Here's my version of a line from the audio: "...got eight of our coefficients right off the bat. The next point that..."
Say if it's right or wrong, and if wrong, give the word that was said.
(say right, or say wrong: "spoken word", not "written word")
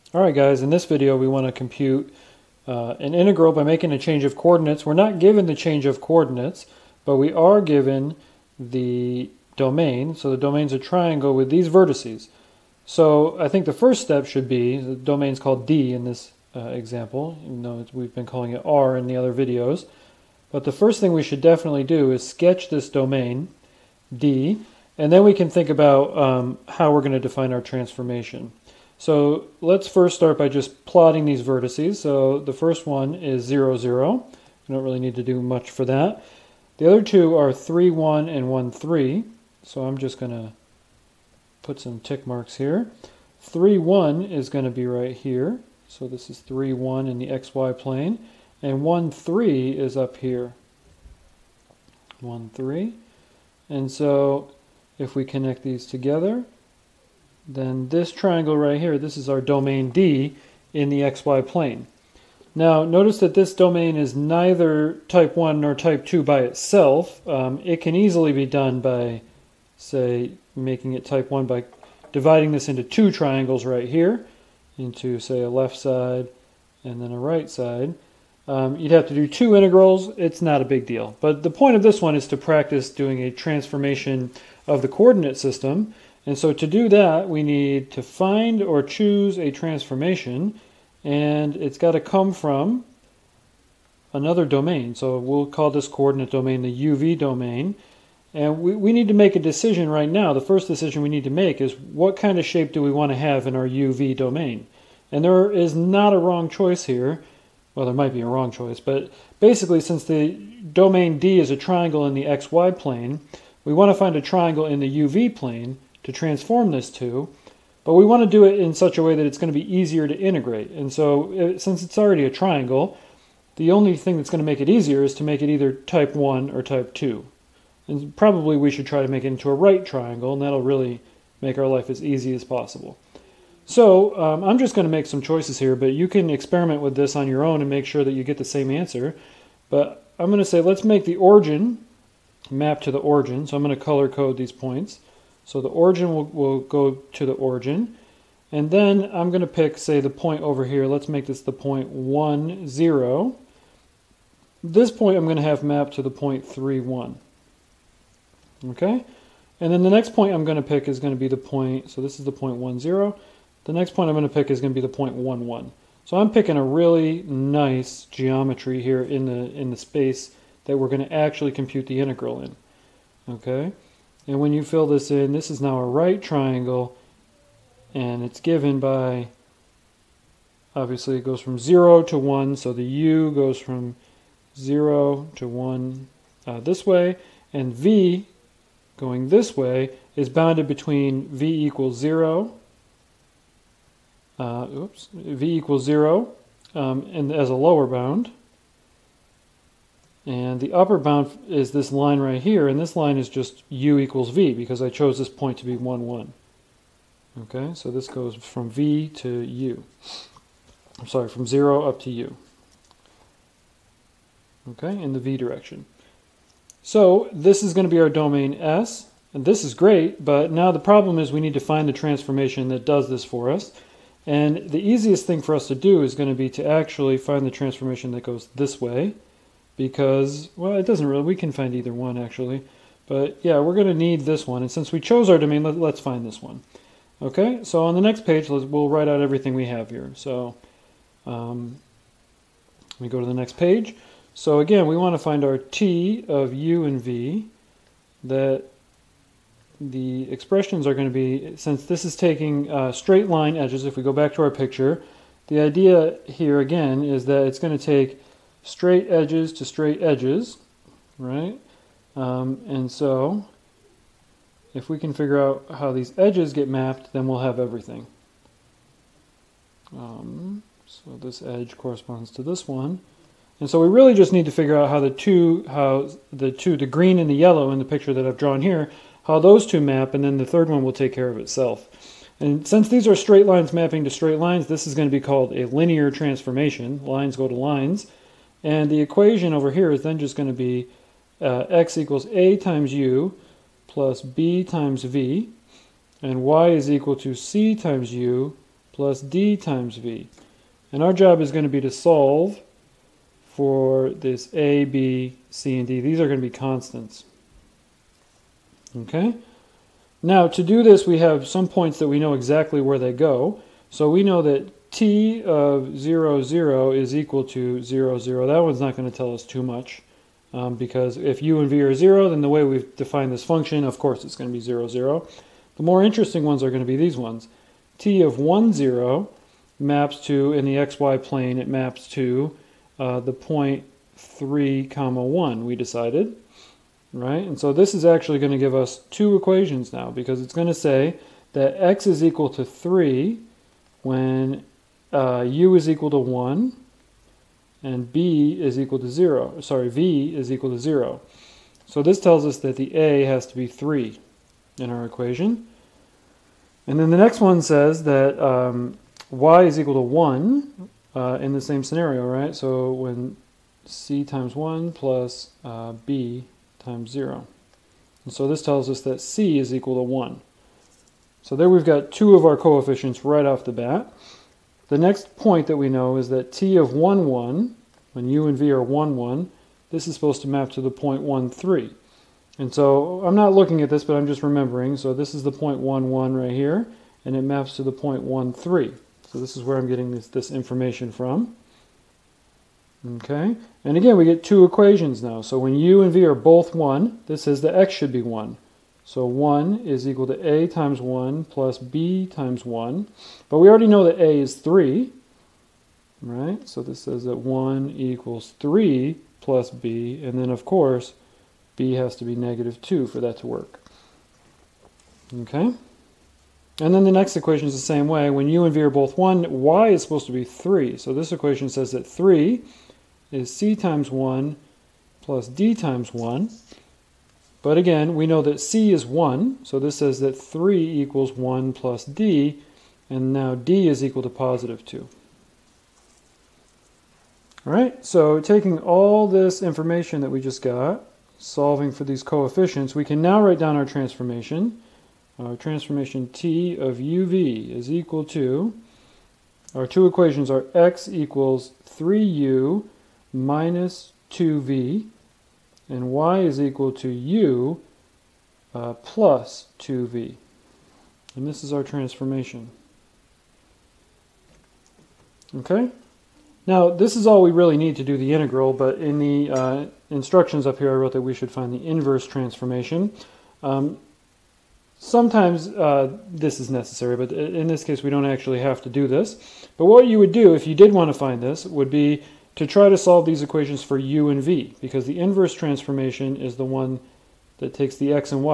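wrong: "two", not "eight".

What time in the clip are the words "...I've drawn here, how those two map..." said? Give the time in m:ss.
4:38.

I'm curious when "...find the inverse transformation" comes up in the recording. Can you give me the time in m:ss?
7:51.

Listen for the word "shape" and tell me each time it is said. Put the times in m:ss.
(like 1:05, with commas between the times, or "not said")
1:42.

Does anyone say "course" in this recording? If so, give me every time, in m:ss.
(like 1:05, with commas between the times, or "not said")
5:23, 6:50.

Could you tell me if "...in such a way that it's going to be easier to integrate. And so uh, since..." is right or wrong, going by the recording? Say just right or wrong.
right.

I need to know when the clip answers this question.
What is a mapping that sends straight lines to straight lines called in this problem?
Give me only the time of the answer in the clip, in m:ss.
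4:45.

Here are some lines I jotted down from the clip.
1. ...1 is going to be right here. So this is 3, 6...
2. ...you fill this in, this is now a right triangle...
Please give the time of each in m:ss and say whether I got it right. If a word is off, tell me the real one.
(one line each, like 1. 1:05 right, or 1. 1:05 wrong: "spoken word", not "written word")
1. 0:43 wrong: "1", not "6"
2. 2:54 right.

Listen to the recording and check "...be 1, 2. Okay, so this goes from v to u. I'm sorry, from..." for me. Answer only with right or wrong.
wrong.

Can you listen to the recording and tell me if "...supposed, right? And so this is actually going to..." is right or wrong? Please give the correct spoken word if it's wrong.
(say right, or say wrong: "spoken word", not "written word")
wrong: "decided", not "supposed".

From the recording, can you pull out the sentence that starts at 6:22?
And so I'm not looking at this, but I'm just remembering.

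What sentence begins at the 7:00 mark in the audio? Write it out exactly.
So this equation says that 3 is c times 1 plus d times 1.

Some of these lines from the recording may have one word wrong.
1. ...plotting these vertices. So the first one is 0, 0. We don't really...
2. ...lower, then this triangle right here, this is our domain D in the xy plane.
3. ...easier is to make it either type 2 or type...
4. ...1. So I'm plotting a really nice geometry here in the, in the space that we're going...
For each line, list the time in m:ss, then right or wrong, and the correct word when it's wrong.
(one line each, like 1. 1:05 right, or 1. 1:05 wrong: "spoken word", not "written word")
1. 0:30 right
2. 0:55 wrong: "together", not "lower"
3. 2:04 wrong: "1", not "2"
4. 2:45 wrong: "picking", not "plotting".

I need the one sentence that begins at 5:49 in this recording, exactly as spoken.
Sorry, v is equal to 0.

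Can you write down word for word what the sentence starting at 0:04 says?
We're not given the change of coordinates, but we are given the domain.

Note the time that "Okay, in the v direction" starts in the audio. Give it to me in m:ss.
3:34.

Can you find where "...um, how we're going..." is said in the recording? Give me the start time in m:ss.
0:26.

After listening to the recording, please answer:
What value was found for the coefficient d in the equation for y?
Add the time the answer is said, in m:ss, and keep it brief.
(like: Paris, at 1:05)
2, at 7:14.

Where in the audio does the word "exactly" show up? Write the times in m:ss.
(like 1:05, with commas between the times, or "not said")
5:12.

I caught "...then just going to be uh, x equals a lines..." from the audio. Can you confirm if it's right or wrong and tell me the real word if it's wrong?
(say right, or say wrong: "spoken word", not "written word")
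wrong: "times", not "lines".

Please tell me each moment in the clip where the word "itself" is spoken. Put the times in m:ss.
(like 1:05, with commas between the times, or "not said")
1:06, 4:41.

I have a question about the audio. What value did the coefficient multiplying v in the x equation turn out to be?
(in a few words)
-2.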